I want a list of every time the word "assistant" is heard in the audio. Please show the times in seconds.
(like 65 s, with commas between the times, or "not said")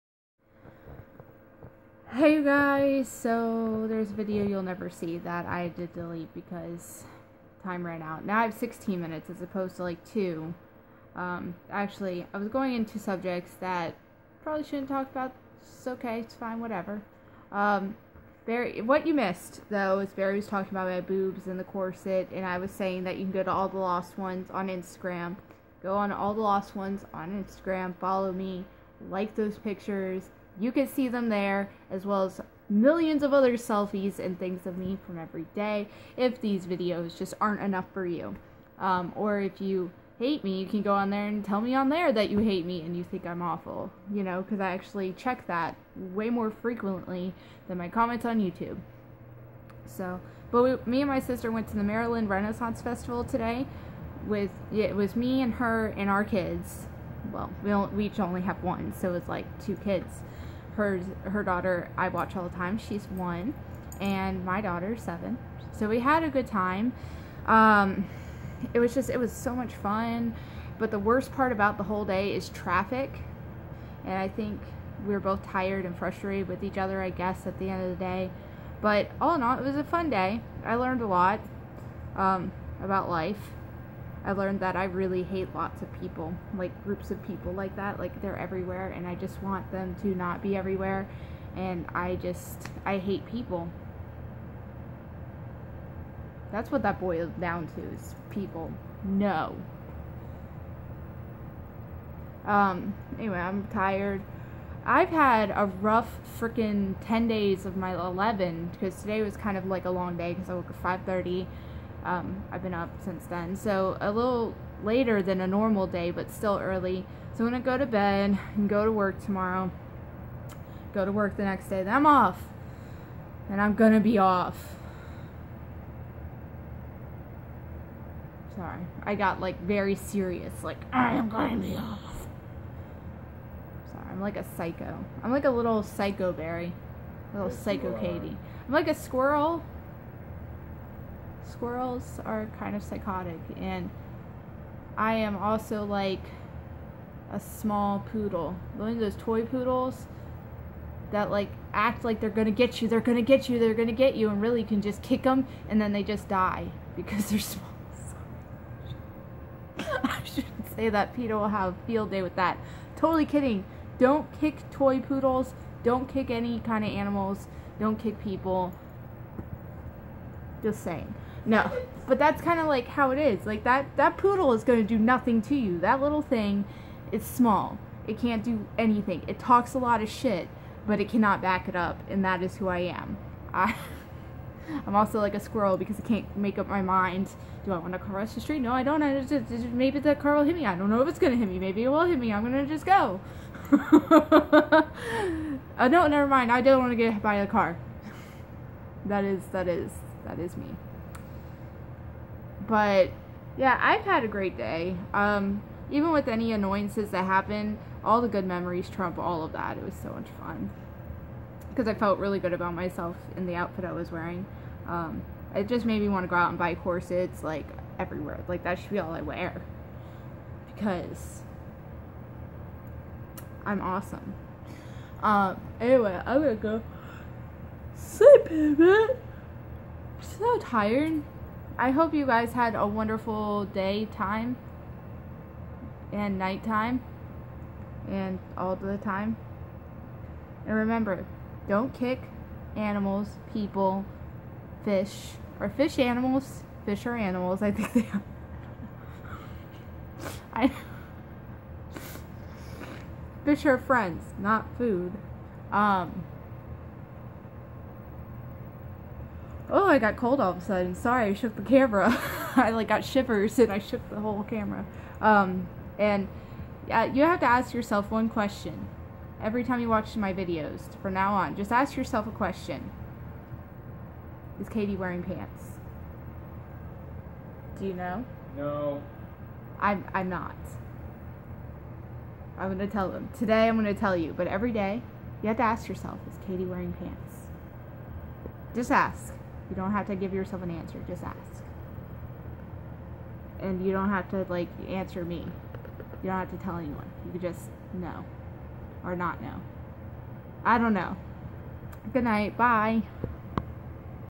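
not said.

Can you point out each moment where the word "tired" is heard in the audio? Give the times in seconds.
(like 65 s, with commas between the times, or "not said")
75 s, 103 s, 230 s.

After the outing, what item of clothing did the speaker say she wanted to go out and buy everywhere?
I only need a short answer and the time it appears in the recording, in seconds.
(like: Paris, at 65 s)
Corsets, at 216 s.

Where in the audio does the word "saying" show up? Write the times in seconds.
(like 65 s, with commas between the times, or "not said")
22 s, 170 s.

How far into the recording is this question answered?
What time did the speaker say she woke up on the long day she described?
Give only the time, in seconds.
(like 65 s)
111 s.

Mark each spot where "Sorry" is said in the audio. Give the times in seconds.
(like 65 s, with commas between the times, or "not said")
128 s, 133 s, 260 s.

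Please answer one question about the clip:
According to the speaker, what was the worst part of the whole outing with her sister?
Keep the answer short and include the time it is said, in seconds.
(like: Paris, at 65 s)
Traffic, at 72 s.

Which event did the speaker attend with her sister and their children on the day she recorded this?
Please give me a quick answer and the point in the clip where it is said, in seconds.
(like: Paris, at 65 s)
Maryland Renaissance Festival, at 51 s.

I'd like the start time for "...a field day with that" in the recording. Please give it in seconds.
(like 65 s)
161 s.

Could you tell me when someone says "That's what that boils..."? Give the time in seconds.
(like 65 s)
96 s.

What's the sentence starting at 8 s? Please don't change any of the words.
Now I have 16 minutes as opposed to like 2.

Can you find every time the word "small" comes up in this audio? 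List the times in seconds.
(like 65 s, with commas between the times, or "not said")
147 s, 157 s, 177 s.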